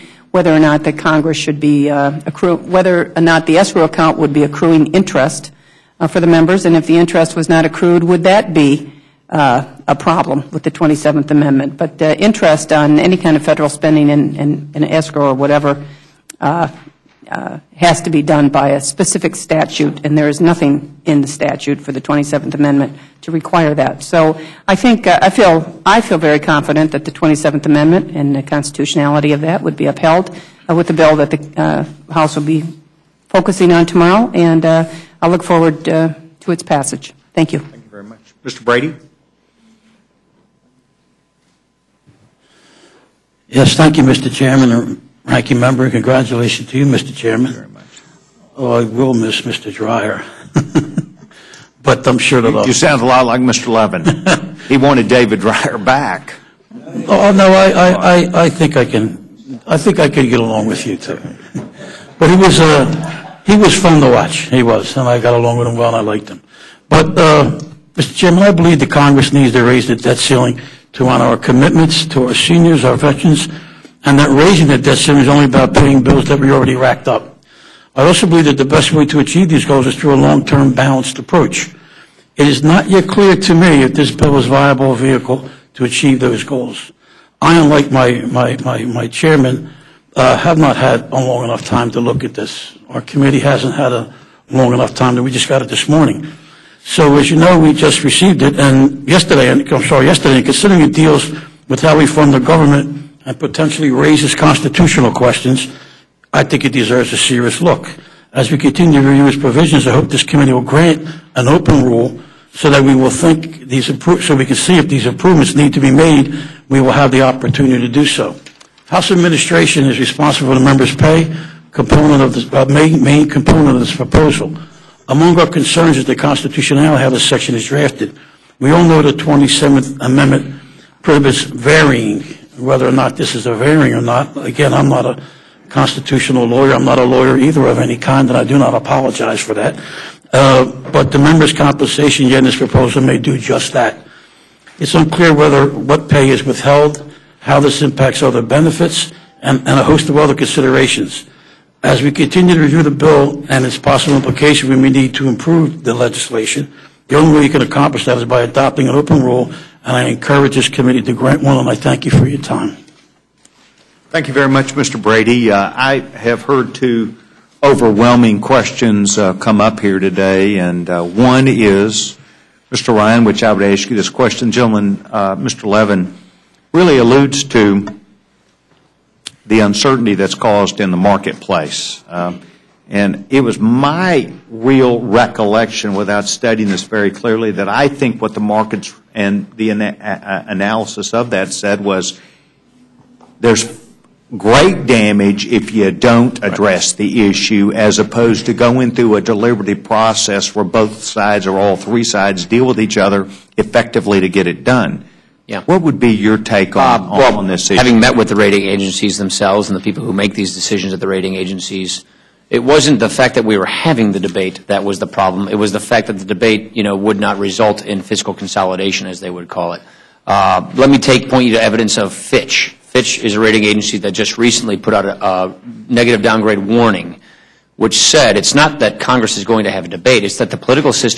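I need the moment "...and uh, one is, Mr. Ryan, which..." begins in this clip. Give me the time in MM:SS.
02:50.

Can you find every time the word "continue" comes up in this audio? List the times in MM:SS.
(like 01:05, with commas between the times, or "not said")
01:48, 02:32.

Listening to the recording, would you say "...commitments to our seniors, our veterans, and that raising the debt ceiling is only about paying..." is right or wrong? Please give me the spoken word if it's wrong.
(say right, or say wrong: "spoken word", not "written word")
right.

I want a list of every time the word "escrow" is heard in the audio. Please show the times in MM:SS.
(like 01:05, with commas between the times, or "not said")
00:03, 00:14.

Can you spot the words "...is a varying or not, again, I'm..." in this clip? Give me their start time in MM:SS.
02:13.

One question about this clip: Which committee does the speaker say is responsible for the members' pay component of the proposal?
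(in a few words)
House administration.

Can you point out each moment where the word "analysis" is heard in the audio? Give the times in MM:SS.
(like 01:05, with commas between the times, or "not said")
03:10.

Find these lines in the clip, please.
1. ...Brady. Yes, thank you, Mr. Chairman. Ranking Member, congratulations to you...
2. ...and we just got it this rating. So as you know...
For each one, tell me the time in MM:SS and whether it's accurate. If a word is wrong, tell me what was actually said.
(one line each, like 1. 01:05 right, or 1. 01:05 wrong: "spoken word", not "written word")
1. 00:38 right
2. 01:35 wrong: "morning", not "rating".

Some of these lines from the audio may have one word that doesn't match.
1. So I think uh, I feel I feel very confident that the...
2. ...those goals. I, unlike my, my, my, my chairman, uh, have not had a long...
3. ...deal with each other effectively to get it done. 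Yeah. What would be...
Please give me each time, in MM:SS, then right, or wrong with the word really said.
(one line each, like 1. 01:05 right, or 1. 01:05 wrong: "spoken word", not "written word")
1. 00:24 right
2. 01:26 right
3. 03:22 right.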